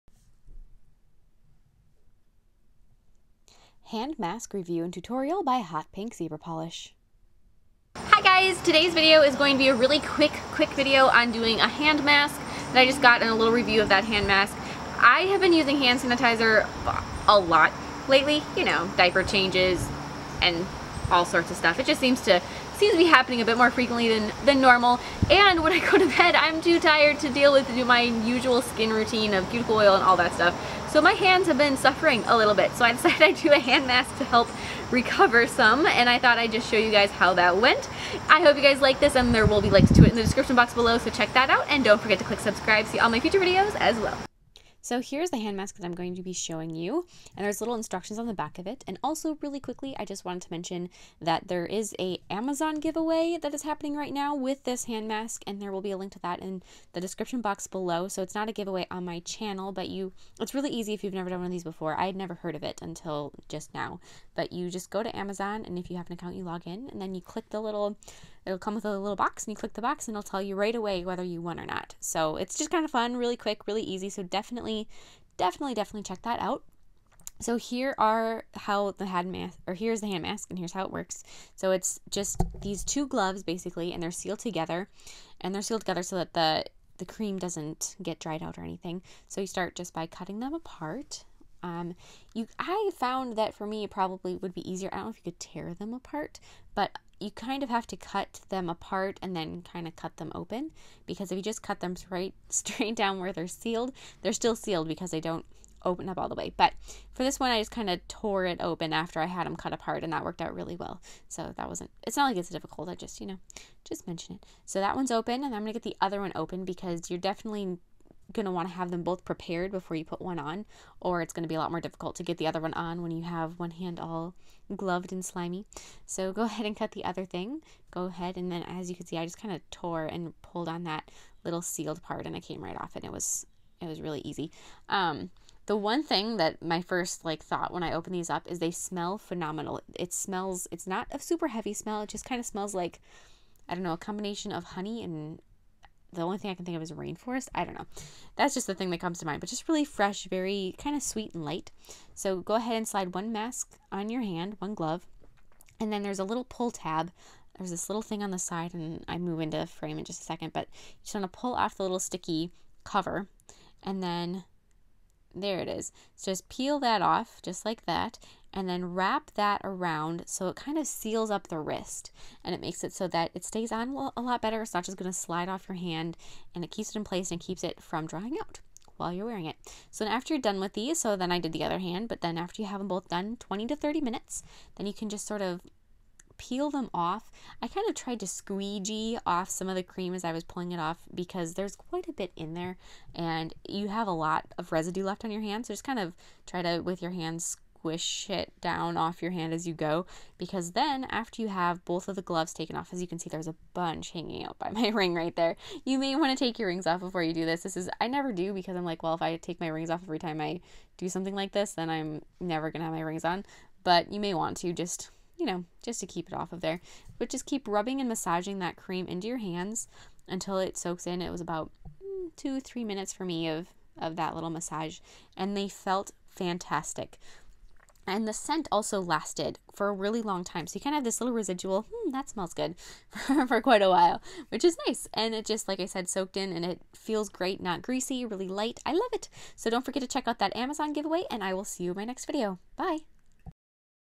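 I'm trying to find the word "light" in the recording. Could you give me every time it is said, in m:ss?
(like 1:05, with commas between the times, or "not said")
2:31, 3:58.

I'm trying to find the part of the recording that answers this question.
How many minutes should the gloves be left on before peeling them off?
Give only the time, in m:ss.
3:03.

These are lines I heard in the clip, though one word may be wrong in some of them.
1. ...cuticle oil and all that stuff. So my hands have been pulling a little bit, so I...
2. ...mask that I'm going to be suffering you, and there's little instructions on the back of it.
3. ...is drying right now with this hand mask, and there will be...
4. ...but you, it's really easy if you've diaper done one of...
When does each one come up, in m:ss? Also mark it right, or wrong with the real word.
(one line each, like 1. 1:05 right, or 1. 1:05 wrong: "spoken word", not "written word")
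1. 0:29 wrong: "suffering", not "pulling"
2. 0:45 wrong: "showing", not "suffering"
3. 0:53 wrong: "happening", not "drying"
4. 0:59 wrong: "never", not "diaper".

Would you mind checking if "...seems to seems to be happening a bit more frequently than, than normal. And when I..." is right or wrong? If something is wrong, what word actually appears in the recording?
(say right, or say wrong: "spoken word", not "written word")
right.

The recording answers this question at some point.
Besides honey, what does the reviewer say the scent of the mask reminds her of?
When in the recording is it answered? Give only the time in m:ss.
2:26.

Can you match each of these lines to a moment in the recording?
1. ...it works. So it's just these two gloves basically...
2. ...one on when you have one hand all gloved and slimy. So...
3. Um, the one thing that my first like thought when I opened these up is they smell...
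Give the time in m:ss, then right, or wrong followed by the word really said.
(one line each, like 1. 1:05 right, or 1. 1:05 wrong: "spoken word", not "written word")
1. 1:20 right
2. 2:02 right
3. 2:14 right.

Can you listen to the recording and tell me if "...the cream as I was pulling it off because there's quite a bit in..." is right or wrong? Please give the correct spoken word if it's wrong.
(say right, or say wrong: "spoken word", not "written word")
right.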